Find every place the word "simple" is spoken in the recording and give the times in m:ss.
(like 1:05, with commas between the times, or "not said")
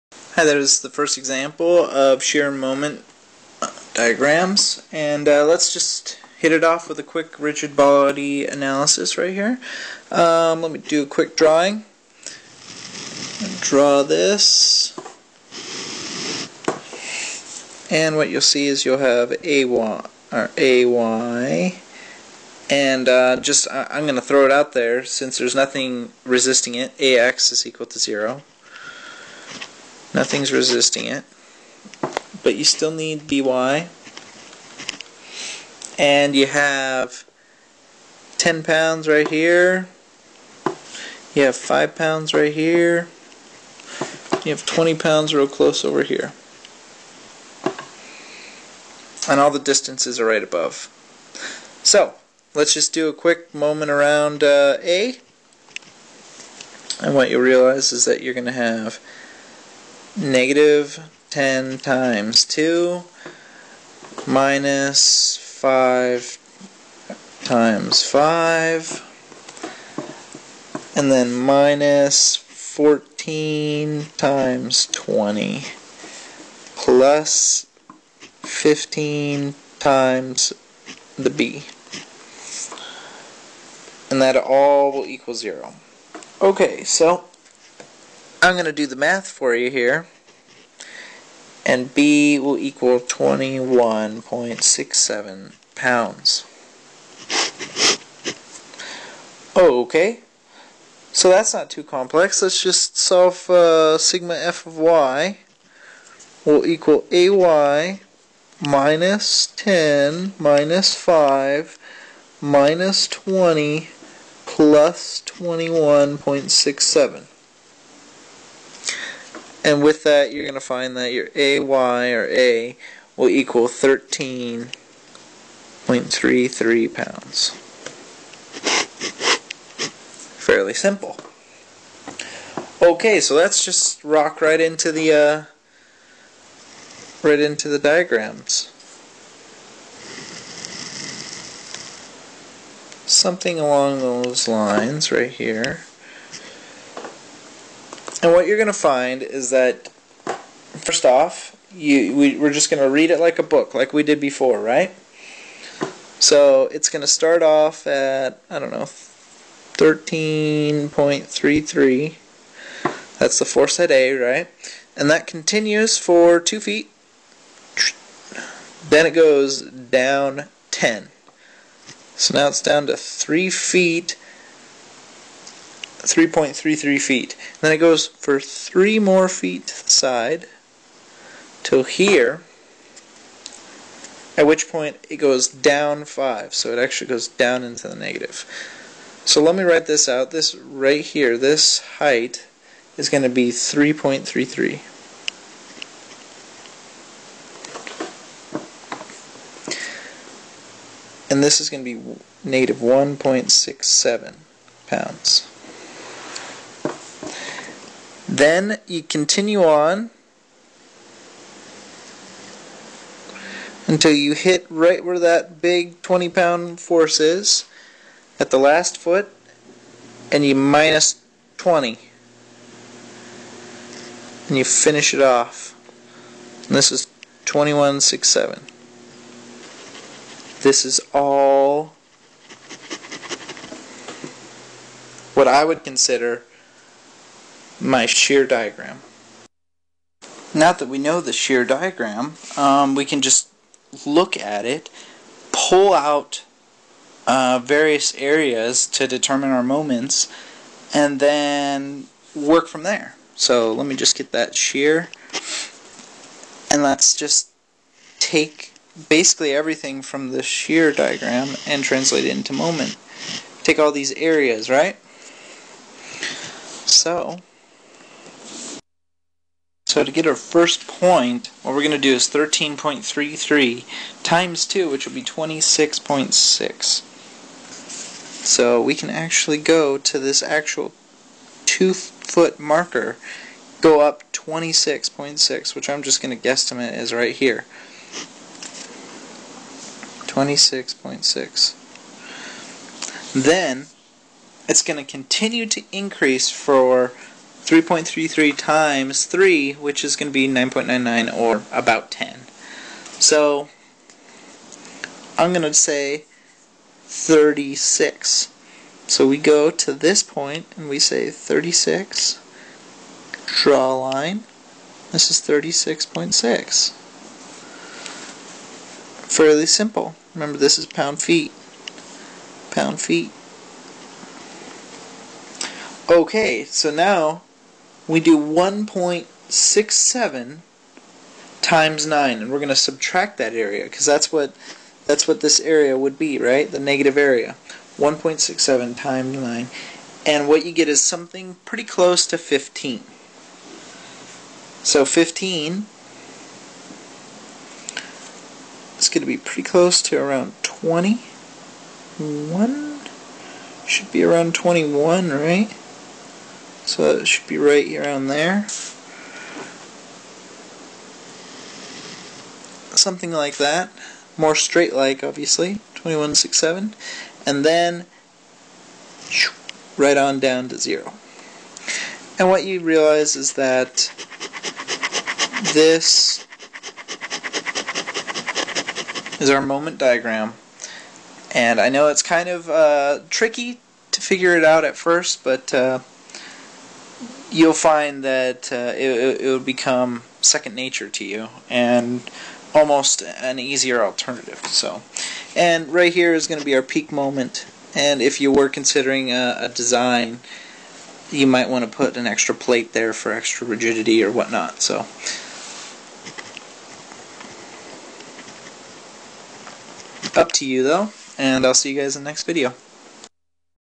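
2:10, 5:19.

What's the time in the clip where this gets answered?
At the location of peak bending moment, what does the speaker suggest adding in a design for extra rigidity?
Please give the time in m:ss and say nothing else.
6:42.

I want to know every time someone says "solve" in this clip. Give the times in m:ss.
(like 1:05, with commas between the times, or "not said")
1:42.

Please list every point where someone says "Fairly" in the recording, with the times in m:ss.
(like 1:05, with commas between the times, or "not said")
2:10, 5:19.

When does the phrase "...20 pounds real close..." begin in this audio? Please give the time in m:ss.
0:44.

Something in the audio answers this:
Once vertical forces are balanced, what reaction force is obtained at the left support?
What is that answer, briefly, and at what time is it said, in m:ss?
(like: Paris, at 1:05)
13.33 pounds, at 2:03.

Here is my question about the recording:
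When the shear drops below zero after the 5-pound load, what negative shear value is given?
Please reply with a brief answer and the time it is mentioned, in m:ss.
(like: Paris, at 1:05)
-1.67 pounds, at 3:22.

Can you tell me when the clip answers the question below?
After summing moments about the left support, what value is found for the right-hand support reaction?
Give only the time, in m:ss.
1:32.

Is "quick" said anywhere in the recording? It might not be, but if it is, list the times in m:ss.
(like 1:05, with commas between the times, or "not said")
0:07, 0:11, 0:53.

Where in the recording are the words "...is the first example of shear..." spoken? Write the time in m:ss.
0:00.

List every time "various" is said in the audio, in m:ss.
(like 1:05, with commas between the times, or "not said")
4:07.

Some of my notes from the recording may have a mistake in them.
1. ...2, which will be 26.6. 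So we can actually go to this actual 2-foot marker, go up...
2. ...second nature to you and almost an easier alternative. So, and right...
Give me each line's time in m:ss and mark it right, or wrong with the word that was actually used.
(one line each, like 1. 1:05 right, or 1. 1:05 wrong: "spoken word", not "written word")
1. 4:34 right
2. 6:30 right.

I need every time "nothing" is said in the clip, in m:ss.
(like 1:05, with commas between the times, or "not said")
0:25, 0:30.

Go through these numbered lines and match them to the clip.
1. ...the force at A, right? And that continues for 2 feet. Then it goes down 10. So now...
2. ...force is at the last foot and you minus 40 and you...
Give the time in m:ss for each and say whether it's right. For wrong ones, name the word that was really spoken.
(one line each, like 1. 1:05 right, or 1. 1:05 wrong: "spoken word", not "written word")
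1. 2:43 right
2. 3:36 wrong: "20", not "40".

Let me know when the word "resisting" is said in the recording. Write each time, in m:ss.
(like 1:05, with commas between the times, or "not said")
0:26, 0:30.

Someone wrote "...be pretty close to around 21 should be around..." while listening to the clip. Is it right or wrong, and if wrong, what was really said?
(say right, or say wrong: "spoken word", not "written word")
right.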